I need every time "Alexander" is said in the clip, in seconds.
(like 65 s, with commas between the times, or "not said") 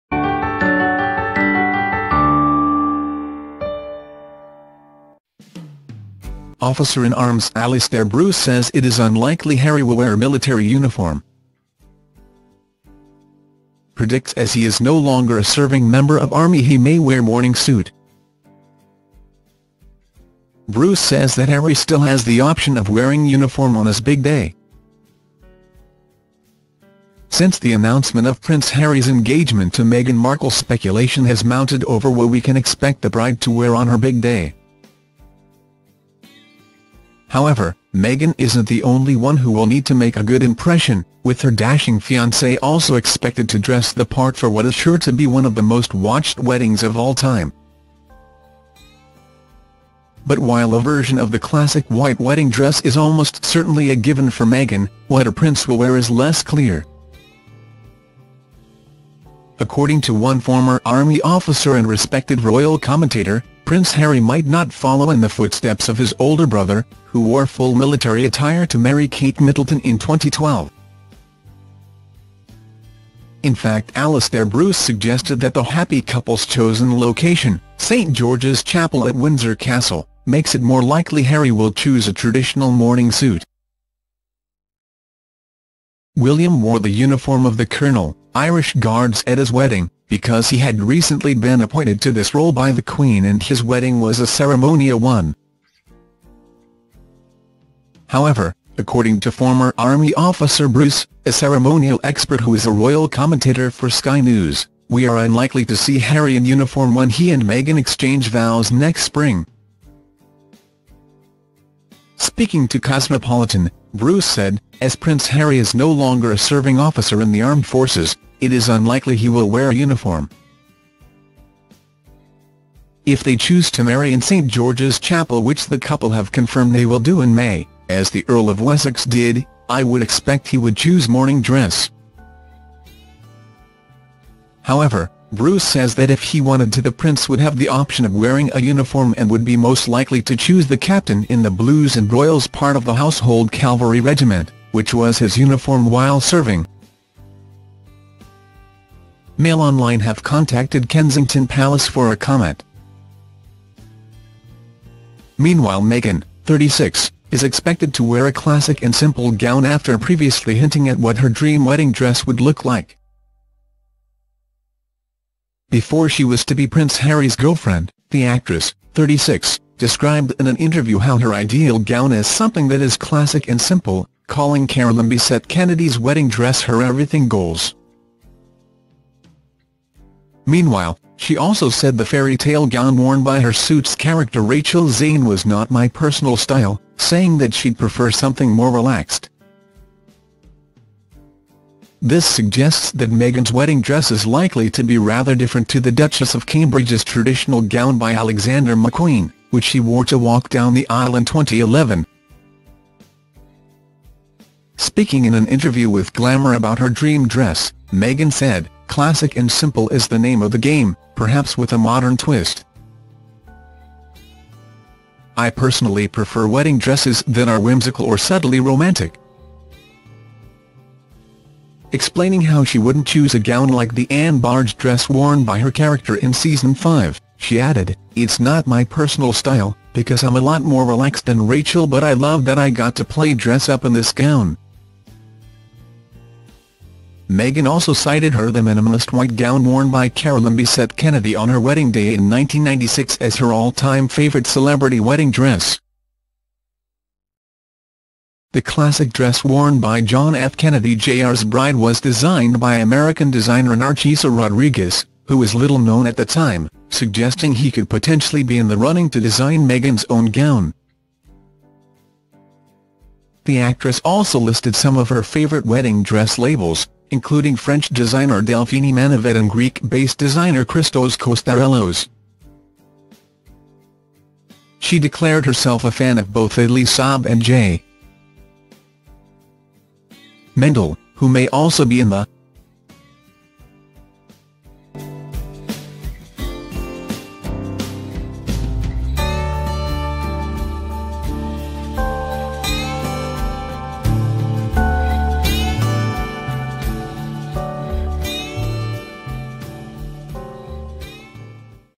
198 s.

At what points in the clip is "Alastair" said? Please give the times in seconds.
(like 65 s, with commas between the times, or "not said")
7 s, 73 s.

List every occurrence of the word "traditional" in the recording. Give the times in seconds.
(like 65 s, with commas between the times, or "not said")
82 s, 197 s.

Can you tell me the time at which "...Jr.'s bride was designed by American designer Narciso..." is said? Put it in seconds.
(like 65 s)
250 s.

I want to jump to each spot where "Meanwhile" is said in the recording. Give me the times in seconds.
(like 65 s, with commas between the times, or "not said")
155 s, 180 s.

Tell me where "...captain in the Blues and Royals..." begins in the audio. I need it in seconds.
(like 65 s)
140 s.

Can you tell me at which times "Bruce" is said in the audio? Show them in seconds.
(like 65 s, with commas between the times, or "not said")
8 s, 20 s, 74 s, 100 s, 113 s, 135 s.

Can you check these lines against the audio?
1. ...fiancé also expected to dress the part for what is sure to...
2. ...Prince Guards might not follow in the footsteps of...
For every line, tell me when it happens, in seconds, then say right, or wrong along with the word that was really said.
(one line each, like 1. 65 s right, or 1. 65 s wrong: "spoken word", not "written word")
1. 42 s right
2. 63 s wrong: "Harry", not "Guards".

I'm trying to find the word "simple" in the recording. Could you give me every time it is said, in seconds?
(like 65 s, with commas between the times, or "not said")
158 s, 173 s, 209 s.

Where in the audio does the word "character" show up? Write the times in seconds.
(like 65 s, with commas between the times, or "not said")
183 s, 225 s.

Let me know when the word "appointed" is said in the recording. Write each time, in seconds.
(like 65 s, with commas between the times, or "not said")
91 s.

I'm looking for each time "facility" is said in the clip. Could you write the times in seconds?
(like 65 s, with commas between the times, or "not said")
not said.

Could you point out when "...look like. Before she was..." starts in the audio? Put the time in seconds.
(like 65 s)
162 s.